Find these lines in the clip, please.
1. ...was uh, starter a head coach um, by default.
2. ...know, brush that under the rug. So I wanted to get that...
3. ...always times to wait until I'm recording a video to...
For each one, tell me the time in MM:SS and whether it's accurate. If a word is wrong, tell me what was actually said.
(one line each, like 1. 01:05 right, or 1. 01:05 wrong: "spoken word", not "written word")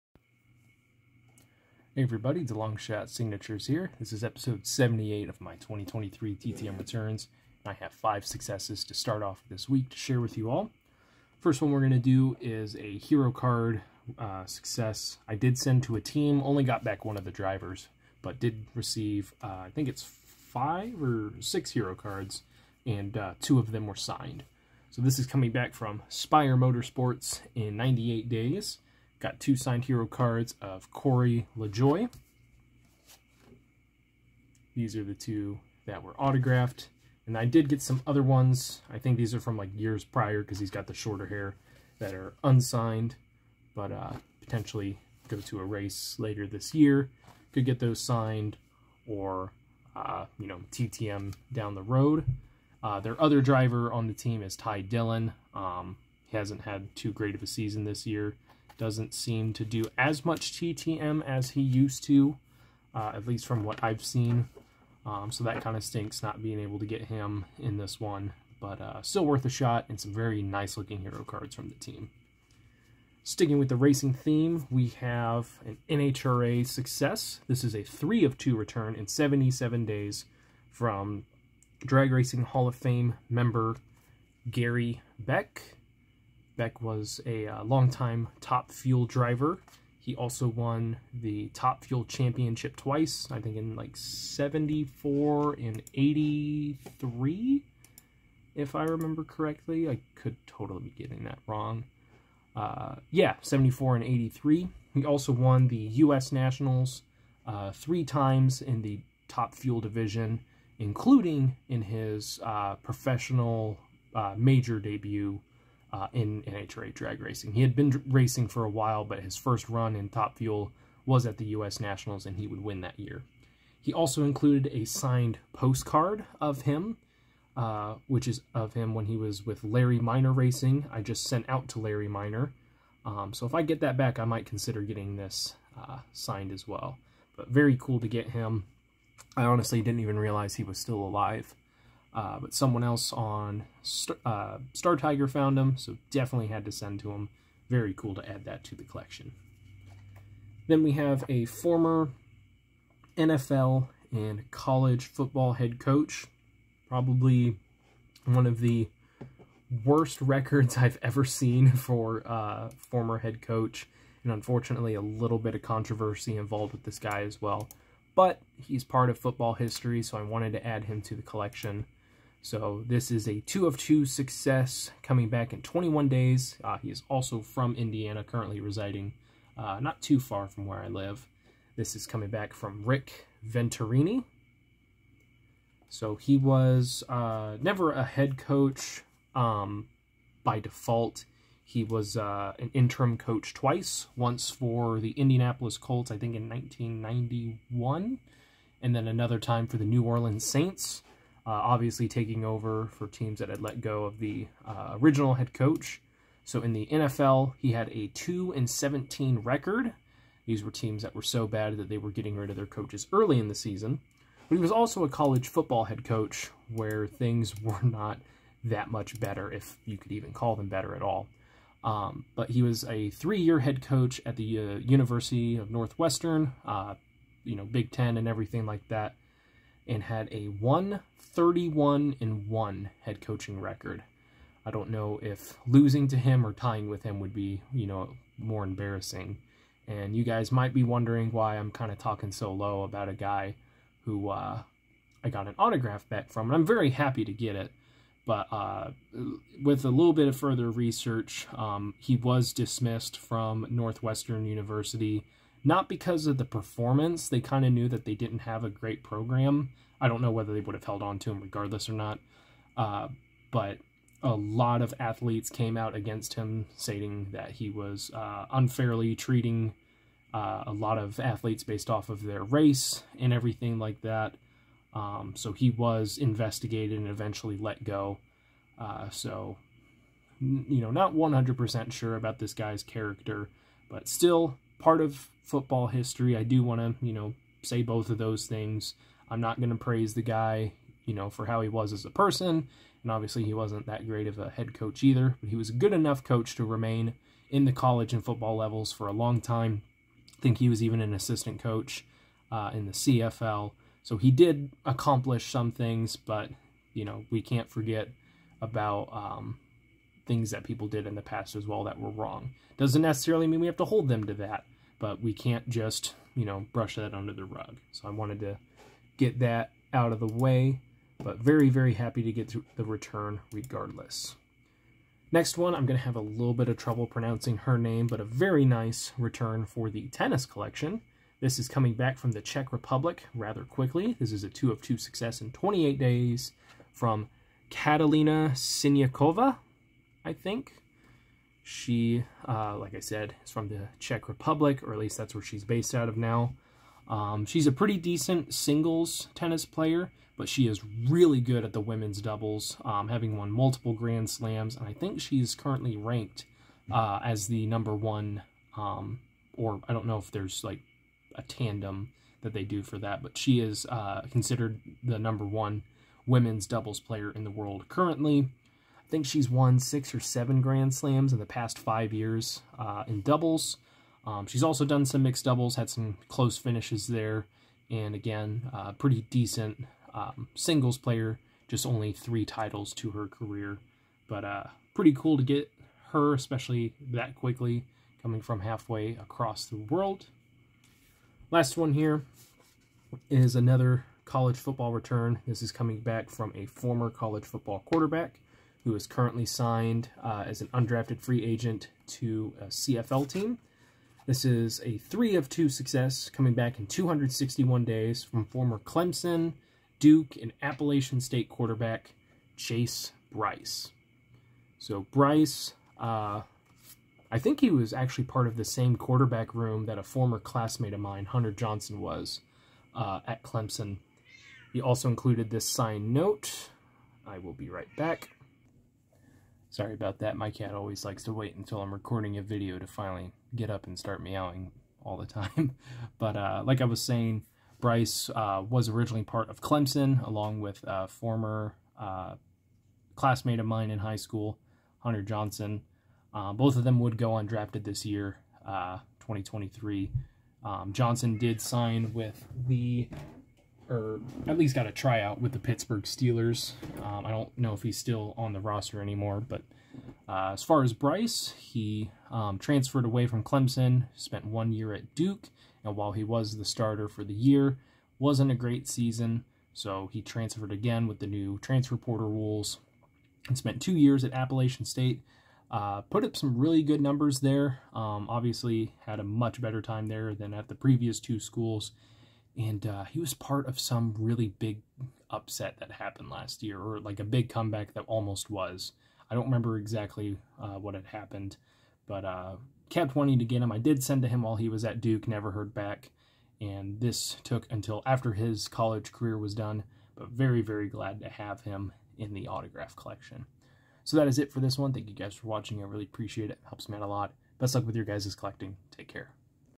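1. 03:06 wrong: "never", not "starter"
2. 05:16 right
3. 07:10 wrong: "likes", not "times".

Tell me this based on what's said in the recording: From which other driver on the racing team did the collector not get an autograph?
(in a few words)
Ty Dillon.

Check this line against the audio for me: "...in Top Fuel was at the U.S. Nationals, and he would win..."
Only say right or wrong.
right.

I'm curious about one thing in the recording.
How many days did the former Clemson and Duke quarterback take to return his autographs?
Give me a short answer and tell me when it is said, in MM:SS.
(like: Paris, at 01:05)
261 days, at 06:46.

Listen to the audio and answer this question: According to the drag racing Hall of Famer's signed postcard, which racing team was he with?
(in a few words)
Larry Minor Racing.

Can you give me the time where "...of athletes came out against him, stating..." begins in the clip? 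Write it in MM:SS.
04:24.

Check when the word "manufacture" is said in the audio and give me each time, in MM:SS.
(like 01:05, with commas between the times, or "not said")
not said.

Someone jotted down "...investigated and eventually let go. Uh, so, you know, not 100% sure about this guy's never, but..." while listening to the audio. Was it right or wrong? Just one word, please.
wrong.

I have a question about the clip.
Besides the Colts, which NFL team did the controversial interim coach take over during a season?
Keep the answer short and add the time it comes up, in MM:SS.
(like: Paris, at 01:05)
New Orleans Saints, at 03:19.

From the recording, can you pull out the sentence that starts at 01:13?
Sticking with the racing theme, we have an NHRA success.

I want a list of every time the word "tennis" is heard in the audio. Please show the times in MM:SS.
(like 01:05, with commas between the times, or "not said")
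05:30, 05:49.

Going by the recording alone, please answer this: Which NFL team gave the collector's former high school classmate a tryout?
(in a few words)
Pittsburgh Steelers.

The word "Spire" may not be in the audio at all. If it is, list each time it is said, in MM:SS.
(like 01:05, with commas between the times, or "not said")
00:26.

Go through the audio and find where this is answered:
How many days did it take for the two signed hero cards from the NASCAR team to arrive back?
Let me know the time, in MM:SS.
00:27.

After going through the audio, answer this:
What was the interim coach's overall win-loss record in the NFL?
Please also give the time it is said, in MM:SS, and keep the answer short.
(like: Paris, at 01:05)
2 and 17, at 03:28.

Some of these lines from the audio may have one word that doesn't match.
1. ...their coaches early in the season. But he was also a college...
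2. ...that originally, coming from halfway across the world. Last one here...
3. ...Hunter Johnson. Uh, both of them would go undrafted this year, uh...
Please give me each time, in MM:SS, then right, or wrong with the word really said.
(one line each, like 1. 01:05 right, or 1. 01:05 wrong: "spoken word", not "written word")
1. 03:32 right
2. 06:27 wrong: "quickly", not "originally"
3. 07:24 right.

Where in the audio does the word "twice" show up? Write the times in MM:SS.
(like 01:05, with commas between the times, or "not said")
01:32, 03:13.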